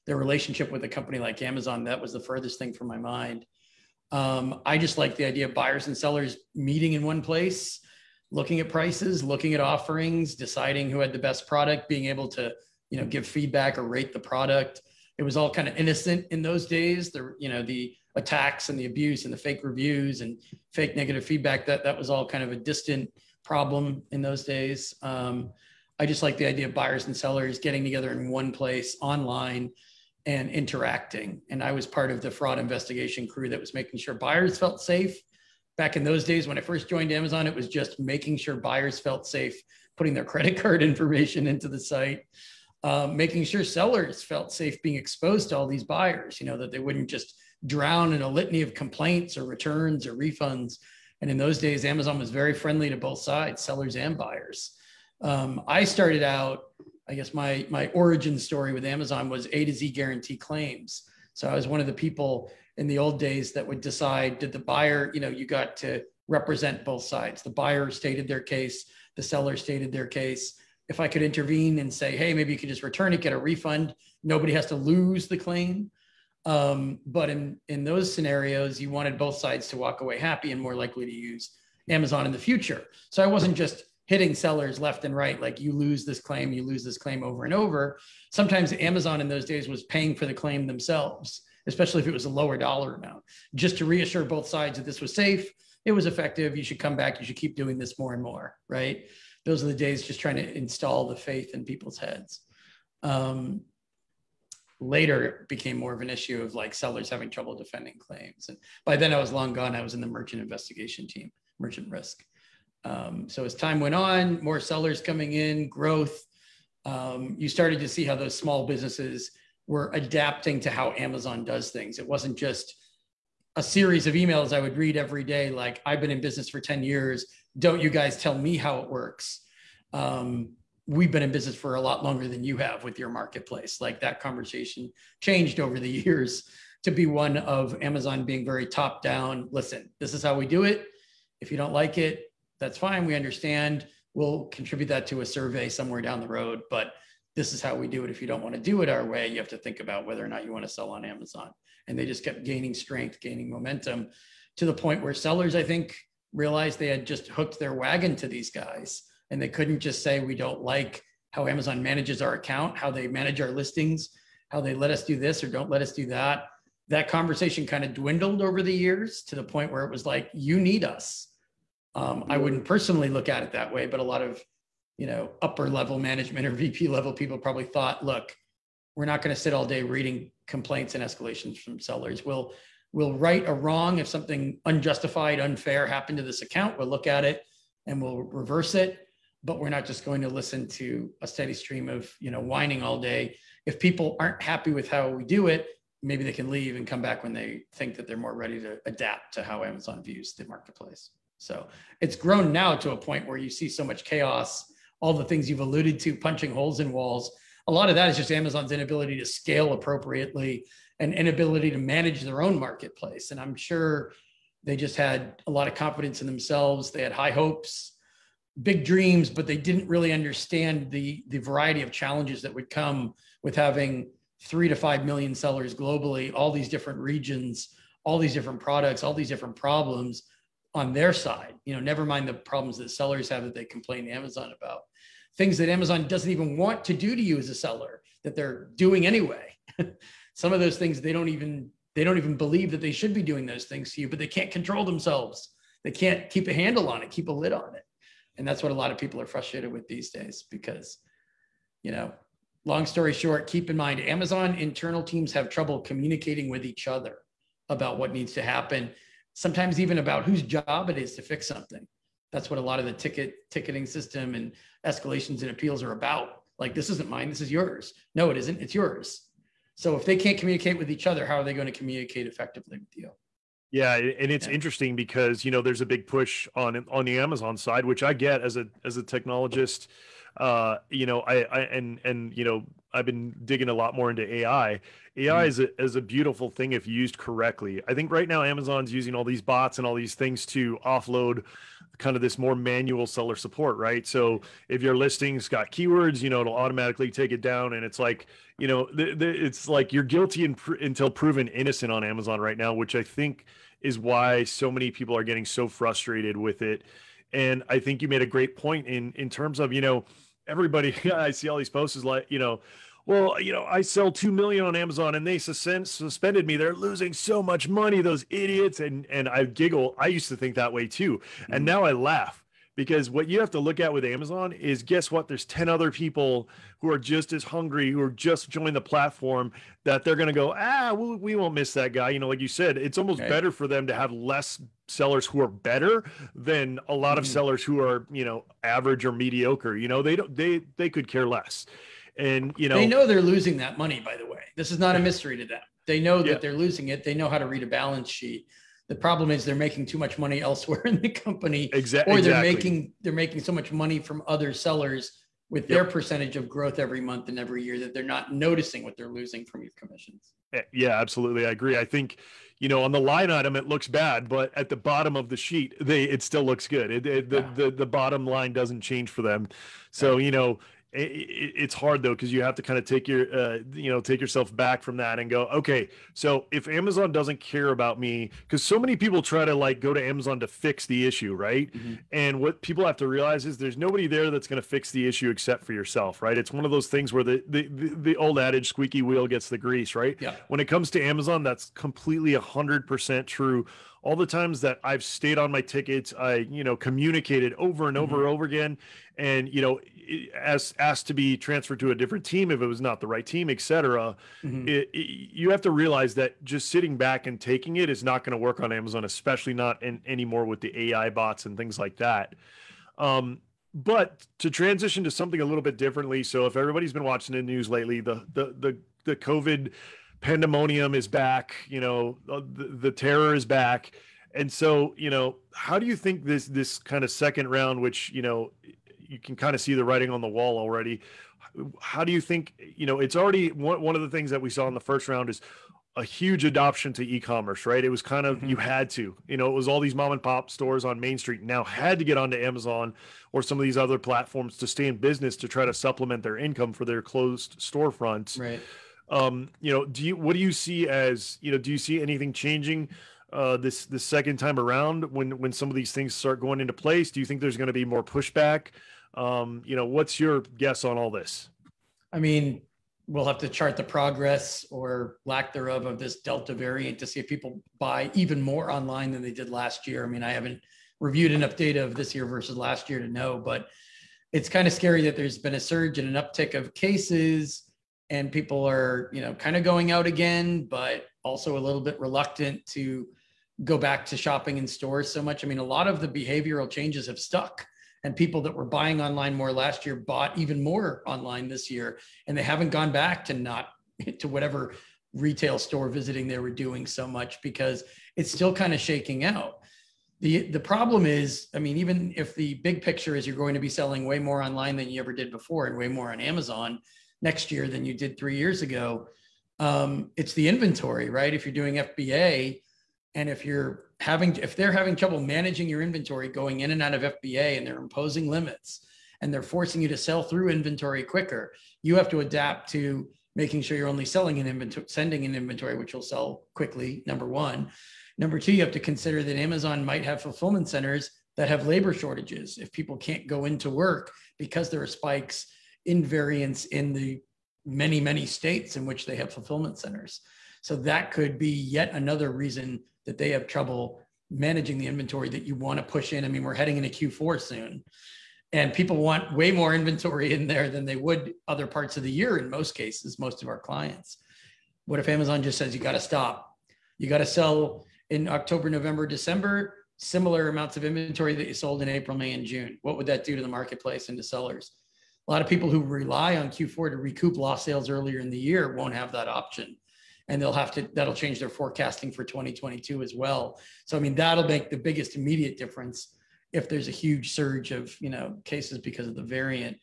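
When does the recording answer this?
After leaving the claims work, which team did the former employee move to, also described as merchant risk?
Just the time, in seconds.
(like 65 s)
110 s.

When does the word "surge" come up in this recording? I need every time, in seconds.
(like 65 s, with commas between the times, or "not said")
475 s, 577 s.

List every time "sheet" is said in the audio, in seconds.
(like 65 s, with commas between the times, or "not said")
348 s, 365 s.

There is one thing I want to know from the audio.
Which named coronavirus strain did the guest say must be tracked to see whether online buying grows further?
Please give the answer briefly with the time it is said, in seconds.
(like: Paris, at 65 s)
Delta, at 466 s.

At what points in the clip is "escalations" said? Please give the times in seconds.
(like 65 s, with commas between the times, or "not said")
181 s, 264 s.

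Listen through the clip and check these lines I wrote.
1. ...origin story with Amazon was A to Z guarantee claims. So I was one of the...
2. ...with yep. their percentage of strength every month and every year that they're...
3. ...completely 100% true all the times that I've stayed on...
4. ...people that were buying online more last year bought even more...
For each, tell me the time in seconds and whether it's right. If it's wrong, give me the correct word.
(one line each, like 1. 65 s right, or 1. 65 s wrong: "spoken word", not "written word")
1. 57 s right
2. 355 s wrong: "growth", not "strength"
3. 391 s right
4. 488 s right.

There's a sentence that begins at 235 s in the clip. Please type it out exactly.
Things that Amazon doesn't even want to do to you as a seller that they're doing anyway.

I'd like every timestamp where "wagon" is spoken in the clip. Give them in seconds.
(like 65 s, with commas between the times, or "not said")
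157 s.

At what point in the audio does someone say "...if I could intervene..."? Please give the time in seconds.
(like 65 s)
70 s.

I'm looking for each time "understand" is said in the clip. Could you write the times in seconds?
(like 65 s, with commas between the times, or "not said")
143 s, 220 s.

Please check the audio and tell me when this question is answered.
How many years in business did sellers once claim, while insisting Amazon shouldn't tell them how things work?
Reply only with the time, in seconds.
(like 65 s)
126 s.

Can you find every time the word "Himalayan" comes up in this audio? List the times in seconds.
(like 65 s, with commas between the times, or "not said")
not said.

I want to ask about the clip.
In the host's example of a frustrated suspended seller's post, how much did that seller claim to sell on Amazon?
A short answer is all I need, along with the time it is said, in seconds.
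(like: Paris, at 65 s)
2 million, at 314 s.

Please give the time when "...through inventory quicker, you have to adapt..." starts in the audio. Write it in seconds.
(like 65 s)
520 s.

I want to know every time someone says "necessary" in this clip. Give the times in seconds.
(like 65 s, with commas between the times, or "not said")
not said.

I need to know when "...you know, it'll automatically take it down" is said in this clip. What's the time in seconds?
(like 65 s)
296 s.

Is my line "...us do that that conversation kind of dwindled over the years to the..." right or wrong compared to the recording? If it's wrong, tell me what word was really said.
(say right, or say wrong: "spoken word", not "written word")
right.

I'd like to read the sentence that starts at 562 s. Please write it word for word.
What would that do to the marketplace and to sellers?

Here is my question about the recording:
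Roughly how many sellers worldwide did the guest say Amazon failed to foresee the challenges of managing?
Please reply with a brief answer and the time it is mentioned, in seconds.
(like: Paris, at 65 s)
three to five million, at 224 s.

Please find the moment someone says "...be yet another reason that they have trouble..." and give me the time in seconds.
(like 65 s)
541 s.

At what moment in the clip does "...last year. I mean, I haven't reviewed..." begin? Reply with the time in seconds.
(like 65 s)
469 s.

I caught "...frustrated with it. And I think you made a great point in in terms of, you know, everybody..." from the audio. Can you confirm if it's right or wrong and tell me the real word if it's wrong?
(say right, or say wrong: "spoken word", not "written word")
right.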